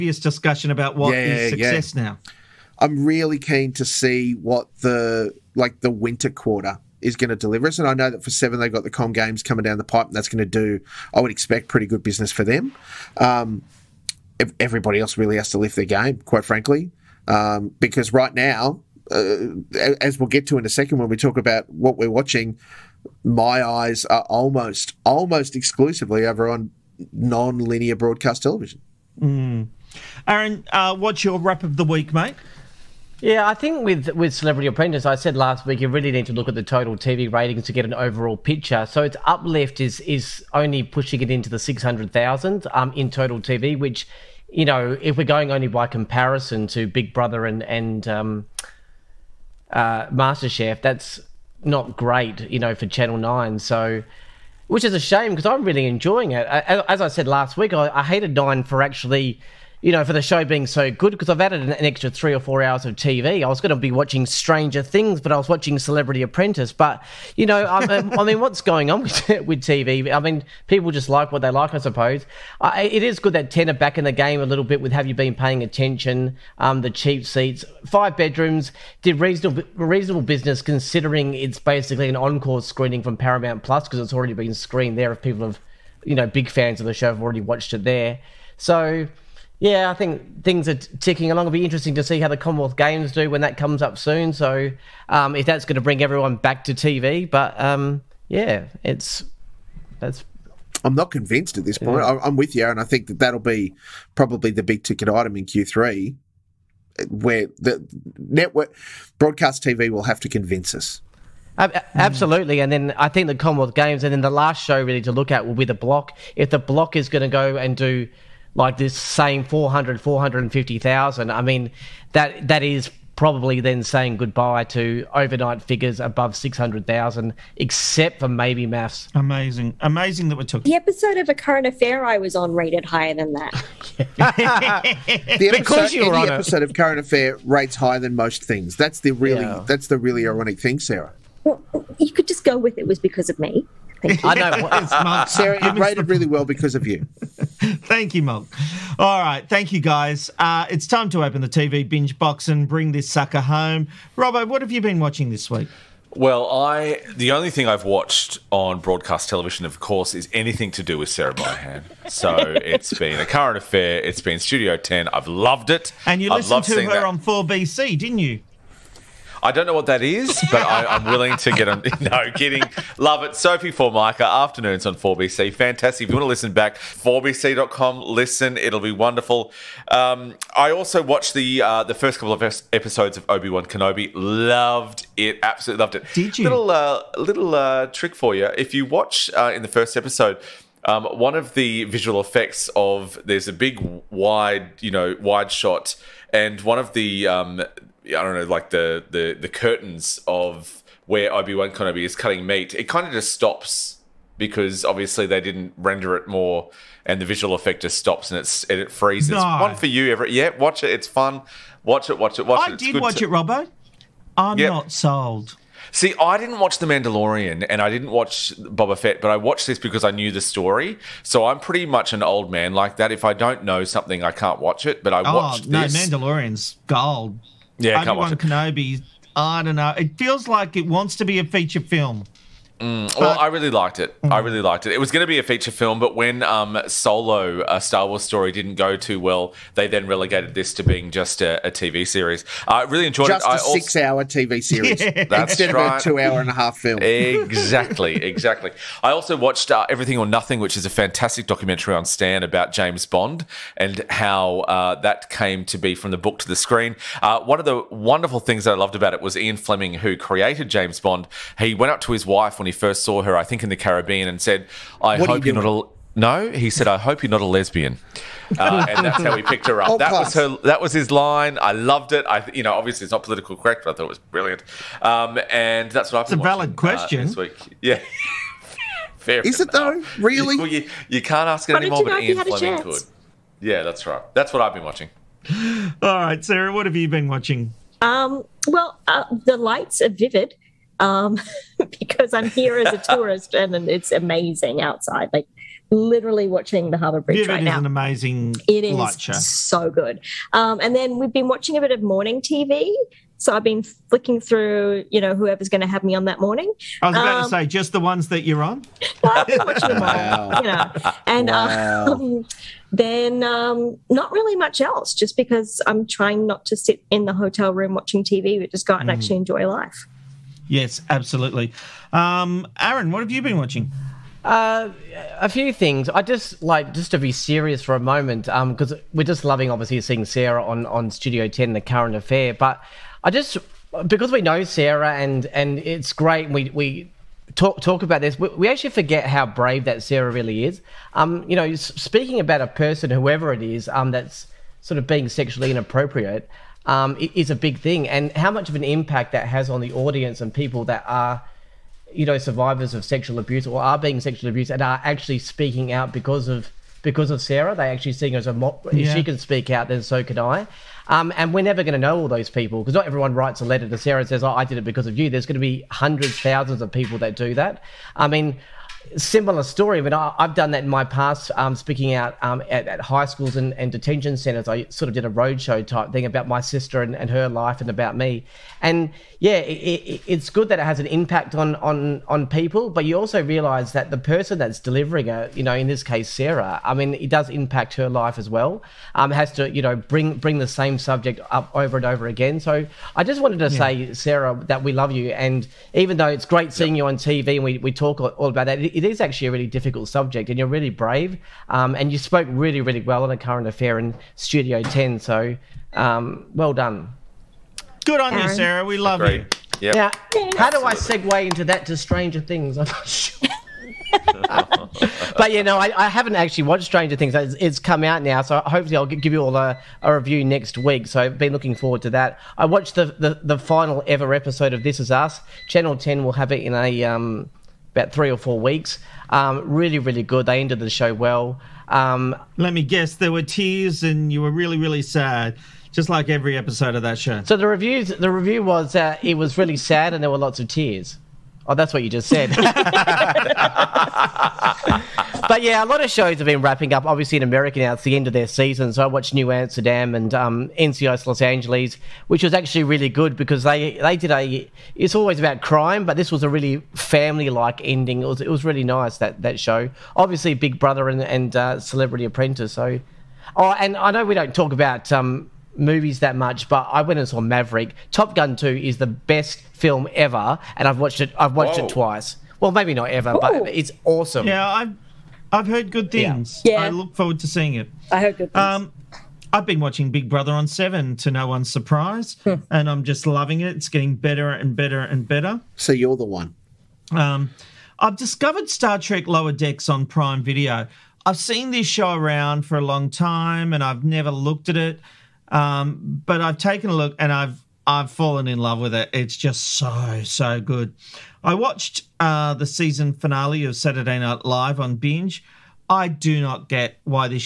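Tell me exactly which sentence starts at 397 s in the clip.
you on TV and we, we talk all about that, it is actually a really difficult subject, and you're really brave.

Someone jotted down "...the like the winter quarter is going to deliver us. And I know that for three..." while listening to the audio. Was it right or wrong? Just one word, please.
wrong.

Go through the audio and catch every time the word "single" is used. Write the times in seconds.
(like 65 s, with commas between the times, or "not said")
not said.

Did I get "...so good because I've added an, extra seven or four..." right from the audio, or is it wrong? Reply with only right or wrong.
wrong.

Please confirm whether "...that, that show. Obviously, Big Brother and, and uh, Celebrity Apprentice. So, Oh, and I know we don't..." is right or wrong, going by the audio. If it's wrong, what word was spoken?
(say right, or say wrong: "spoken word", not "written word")
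right.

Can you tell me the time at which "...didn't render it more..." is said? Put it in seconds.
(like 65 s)
205 s.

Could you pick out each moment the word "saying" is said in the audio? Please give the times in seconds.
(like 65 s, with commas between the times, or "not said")
118 s, 123 s.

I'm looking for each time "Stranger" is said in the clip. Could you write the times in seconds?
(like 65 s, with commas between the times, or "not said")
64 s, 411 s, 416 s.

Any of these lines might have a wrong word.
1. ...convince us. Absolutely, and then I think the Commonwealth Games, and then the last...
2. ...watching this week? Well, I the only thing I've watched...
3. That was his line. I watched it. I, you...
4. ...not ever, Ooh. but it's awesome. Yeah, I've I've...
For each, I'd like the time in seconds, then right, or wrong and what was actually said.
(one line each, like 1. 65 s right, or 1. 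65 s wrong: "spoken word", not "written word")
1. 110 s right
2. 154 s right
3. 270 s wrong: "loved", not "watched"
4. 472 s right.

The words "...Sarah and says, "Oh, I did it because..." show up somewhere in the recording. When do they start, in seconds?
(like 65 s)
363 s.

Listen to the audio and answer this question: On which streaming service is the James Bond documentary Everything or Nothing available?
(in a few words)
Stan.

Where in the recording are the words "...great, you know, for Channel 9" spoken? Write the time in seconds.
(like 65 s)
51 s.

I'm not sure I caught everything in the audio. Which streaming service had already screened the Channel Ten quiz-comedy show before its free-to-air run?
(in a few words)
Paramount Plus.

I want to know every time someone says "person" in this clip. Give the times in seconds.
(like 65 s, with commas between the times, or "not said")
342 s, 384 s.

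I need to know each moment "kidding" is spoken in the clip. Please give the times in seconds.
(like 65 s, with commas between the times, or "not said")
172 s.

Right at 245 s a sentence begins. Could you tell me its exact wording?
of a two-hour and a half film.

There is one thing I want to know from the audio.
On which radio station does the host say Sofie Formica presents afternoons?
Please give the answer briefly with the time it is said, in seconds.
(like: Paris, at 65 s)
4BC, at 174 s.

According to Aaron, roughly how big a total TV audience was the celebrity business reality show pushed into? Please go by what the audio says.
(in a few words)
600,000.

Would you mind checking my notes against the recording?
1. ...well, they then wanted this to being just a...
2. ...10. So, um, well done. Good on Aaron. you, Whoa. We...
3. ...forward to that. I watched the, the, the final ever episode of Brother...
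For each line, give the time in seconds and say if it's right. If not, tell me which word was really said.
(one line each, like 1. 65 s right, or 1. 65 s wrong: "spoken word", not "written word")
1. 239 s wrong: "relegated", not "wanted"
2. 404 s wrong: "Sarah", not "Whoa"
3. 421 s wrong: "This", not "Brother".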